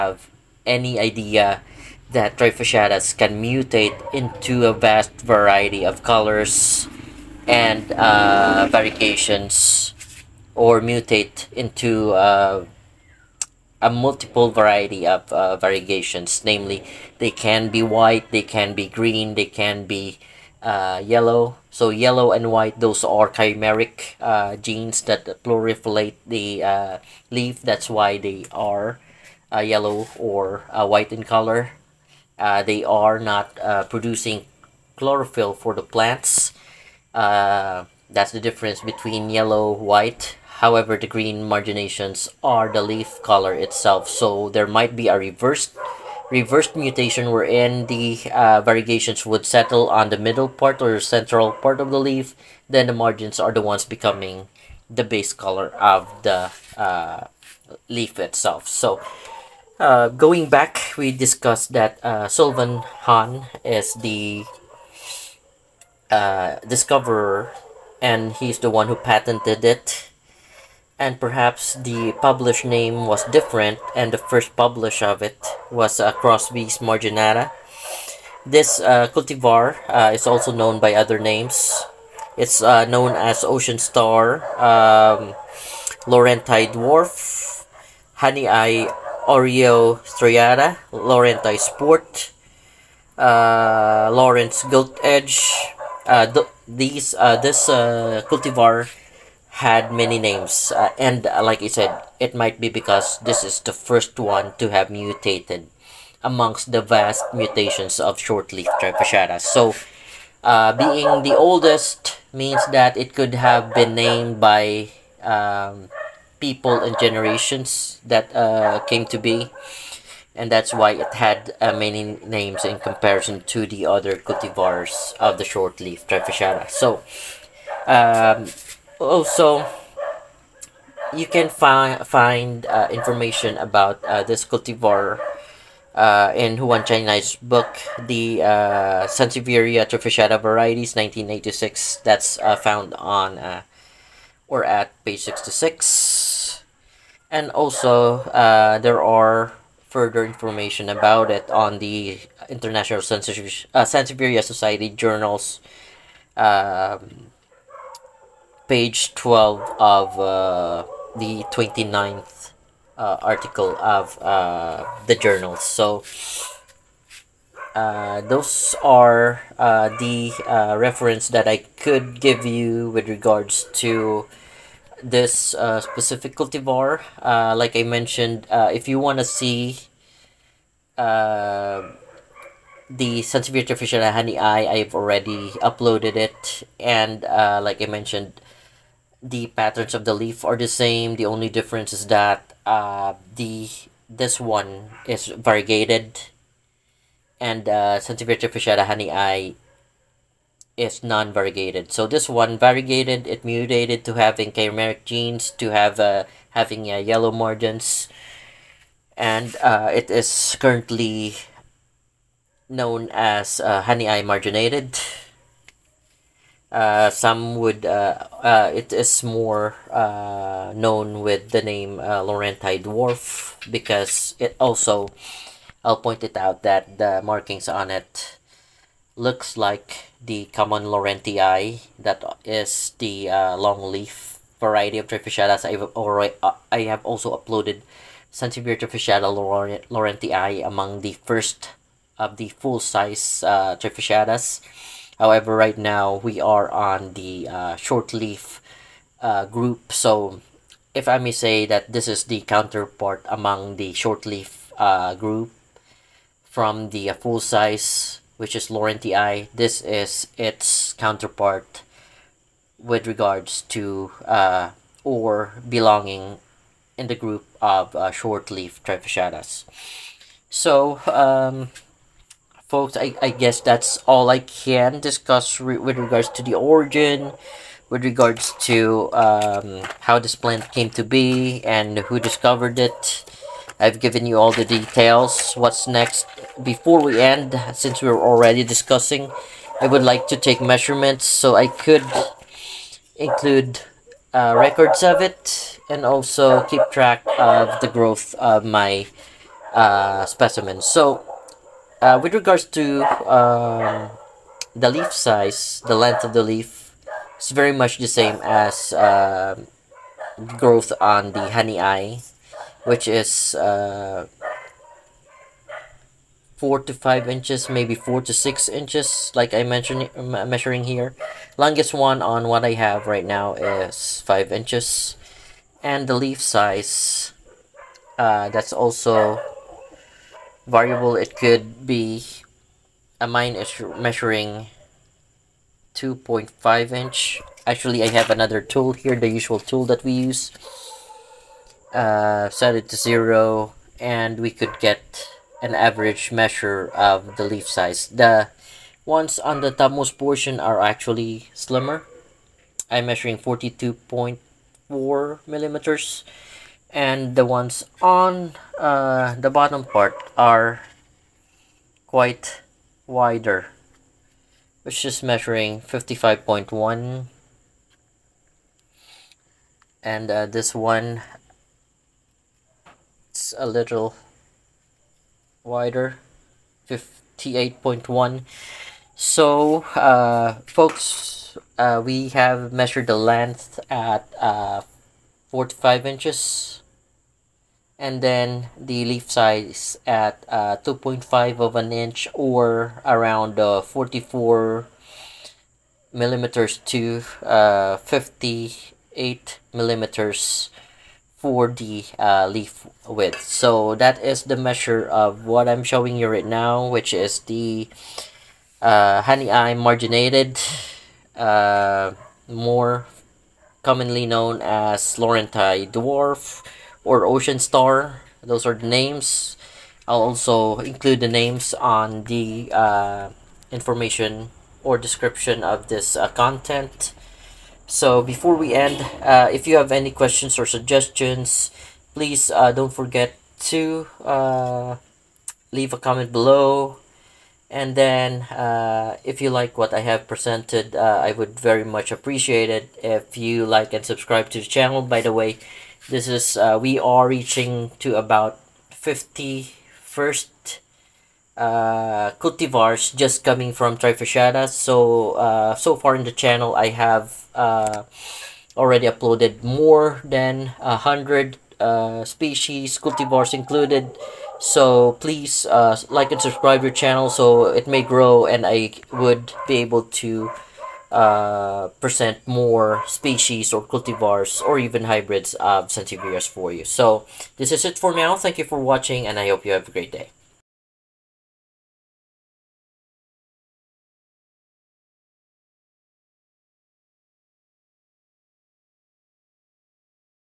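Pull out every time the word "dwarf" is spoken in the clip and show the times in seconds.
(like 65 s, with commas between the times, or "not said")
86 s, 222 s, 415 s.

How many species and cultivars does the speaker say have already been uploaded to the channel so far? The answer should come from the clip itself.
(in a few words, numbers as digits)
More than 100.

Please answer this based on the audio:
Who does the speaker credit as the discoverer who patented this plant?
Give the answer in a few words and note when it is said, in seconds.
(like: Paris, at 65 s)
Sylvan Hahn, at 62 s.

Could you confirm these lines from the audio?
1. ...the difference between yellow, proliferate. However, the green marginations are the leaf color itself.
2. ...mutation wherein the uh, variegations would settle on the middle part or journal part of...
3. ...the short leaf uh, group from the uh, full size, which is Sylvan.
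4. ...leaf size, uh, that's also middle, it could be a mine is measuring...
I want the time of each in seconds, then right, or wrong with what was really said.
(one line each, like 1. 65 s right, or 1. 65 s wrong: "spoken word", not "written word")
1. 38 s wrong: "white", not "proliferate"
2. 46 s wrong: "central", not "journal"
3. 253 s wrong: "Laurentii", not "Sylvan"
4. 326 s wrong: "variable", not "middle".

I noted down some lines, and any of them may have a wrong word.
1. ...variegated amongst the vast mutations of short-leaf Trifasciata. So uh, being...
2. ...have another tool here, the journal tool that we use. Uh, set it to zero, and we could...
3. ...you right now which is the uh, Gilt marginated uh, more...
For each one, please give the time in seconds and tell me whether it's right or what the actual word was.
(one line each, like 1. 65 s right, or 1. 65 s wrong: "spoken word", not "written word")
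1. 104 s wrong: "mutated", not "variegated"
2. 338 s wrong: "usual", not "journal"
3. 406 s wrong: "Hahnii", not "Gilt".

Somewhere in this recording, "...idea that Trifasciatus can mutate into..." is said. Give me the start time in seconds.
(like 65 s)
0 s.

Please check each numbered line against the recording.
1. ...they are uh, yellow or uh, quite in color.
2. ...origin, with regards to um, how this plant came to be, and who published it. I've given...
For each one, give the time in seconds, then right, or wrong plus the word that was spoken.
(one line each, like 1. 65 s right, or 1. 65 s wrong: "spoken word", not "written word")
1. 28 s wrong: "white", not "quite"
2. 276 s wrong: "discovered", not "published".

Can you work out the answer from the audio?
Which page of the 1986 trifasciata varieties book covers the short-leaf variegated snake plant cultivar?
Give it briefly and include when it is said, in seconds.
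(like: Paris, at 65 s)
66, at 145 s.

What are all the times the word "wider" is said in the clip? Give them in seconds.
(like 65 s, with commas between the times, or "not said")
363 s, 375 s.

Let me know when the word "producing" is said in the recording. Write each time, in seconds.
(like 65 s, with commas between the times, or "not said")
33 s.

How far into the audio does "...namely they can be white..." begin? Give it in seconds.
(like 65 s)
16 s.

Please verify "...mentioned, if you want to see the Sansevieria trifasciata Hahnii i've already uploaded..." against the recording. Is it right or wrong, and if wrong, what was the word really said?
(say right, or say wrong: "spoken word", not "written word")
right.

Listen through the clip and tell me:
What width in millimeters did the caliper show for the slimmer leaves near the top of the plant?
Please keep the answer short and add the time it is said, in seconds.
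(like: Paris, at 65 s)
42.4 millimeters, at 353 s.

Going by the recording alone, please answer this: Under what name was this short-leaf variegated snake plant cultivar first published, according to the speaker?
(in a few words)
Crosby's Marginata.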